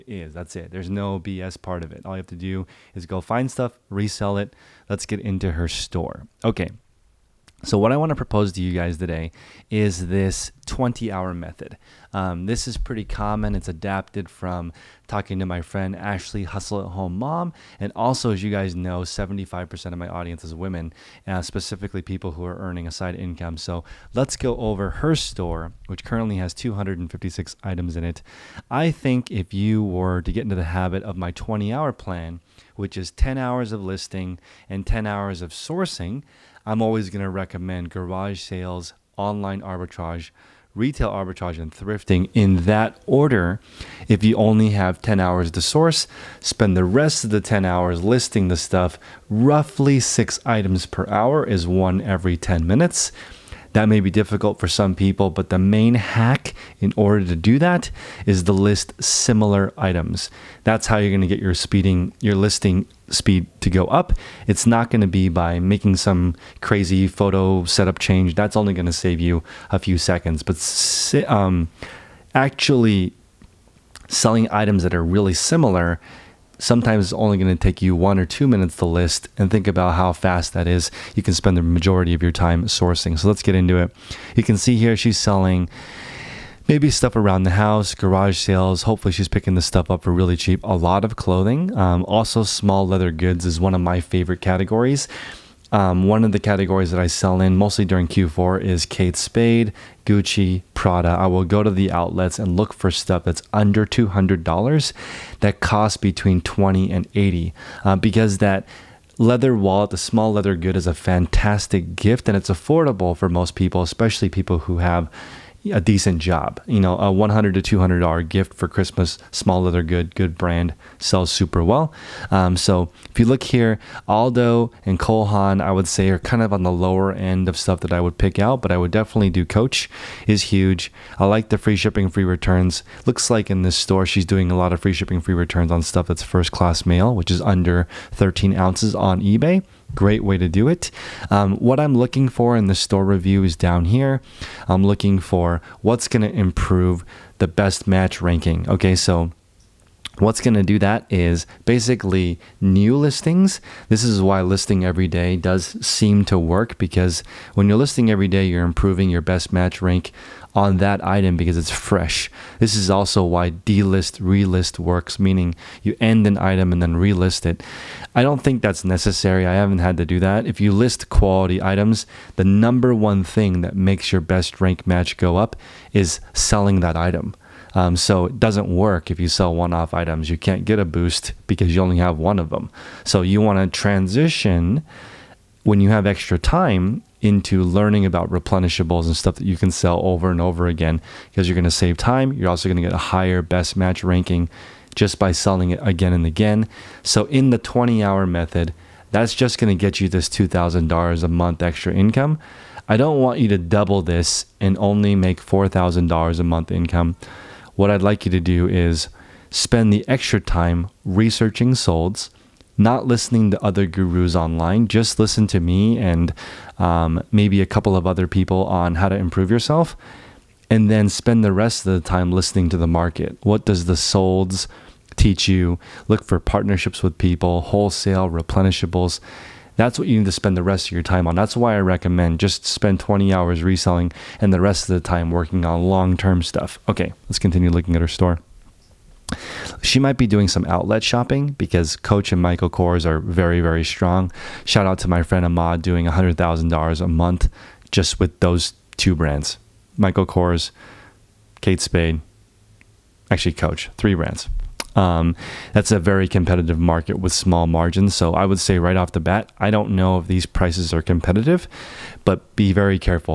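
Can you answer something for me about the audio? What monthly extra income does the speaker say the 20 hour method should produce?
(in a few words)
$2,000.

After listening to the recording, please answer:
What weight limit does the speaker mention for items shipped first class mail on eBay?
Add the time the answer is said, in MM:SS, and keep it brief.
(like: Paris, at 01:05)
13 ounces, at 02:18.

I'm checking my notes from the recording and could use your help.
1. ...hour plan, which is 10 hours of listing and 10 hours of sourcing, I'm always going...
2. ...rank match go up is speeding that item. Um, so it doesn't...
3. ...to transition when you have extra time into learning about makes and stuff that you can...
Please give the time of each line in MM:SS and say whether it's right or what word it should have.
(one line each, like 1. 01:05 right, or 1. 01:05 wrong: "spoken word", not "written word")
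1. 00:31 right
2. 02:54 wrong: "selling", not "speeding"
3. 03:03 wrong: "replenishables", not "makes".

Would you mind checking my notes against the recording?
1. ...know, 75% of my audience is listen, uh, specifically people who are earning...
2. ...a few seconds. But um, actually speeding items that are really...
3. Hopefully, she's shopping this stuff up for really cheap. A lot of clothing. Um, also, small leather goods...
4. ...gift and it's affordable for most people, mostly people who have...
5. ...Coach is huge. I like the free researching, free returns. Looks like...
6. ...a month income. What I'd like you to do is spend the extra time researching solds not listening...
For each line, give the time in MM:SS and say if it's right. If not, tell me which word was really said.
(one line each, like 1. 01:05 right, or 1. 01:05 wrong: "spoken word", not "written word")
1. 00:18 wrong: "women", not "listen"
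2. 01:09 wrong: "selling", not "speeding"
3. 01:28 wrong: "picking", not "shopping"
4. 01:51 wrong: "especially", not "mostly"
5. 02:09 wrong: "shipping", not "researching"
6. 03:26 right.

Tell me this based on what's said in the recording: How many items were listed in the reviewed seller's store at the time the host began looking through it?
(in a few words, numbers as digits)
256.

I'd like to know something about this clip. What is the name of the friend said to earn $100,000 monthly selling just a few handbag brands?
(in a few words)
Ahmad.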